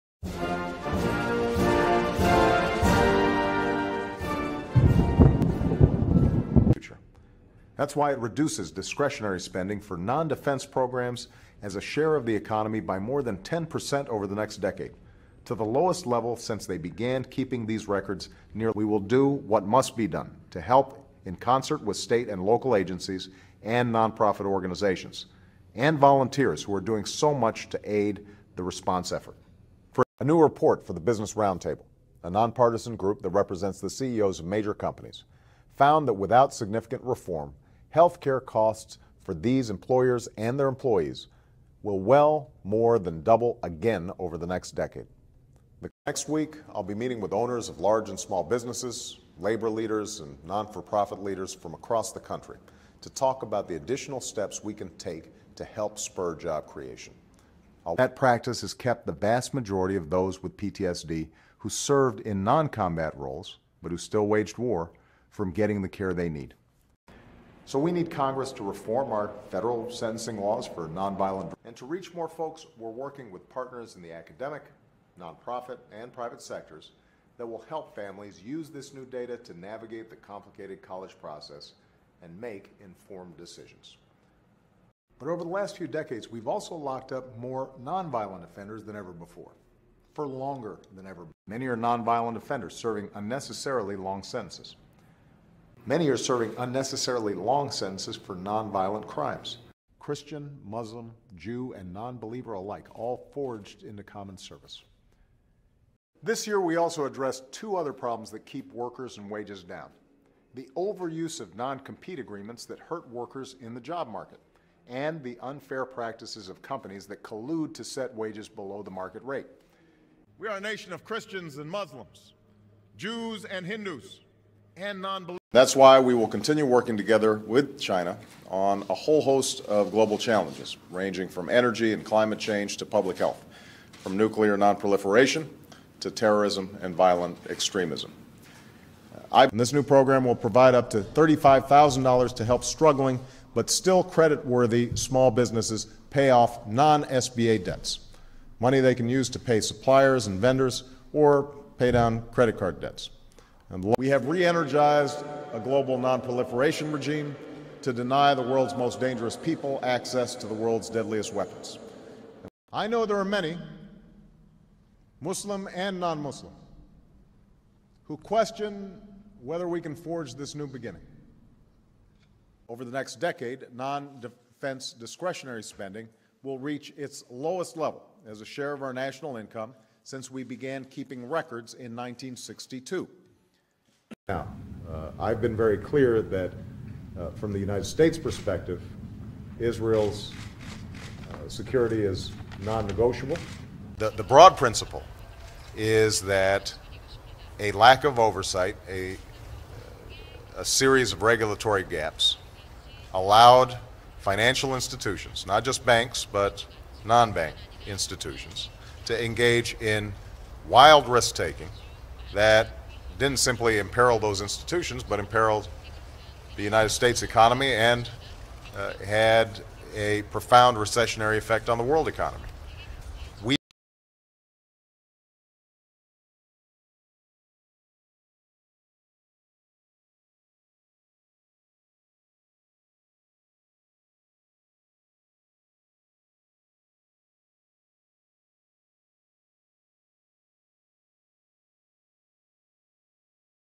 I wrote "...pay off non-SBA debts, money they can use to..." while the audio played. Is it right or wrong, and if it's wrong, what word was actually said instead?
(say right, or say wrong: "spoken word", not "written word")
right.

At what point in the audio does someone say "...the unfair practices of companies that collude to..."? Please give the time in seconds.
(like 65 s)
115 s.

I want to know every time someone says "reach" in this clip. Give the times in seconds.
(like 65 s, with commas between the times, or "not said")
71 s, 176 s.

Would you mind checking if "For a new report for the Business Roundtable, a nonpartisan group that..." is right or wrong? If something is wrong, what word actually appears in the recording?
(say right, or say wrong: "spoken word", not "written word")
right.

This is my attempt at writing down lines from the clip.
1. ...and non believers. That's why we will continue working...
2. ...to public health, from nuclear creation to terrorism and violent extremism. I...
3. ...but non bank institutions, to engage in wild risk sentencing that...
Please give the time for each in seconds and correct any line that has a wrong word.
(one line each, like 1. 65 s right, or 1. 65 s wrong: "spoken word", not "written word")
1. 124 s right
2. 132 s wrong: "nonproliferation", not "creation"
3. 206 s wrong: "taking", not "sentencing".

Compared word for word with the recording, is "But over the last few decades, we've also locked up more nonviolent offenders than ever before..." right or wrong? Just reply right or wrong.
right.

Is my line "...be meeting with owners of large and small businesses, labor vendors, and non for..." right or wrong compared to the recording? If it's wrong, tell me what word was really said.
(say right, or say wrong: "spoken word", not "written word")
wrong: "leaders", not "vendors".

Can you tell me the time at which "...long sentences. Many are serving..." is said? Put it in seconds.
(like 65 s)
93 s.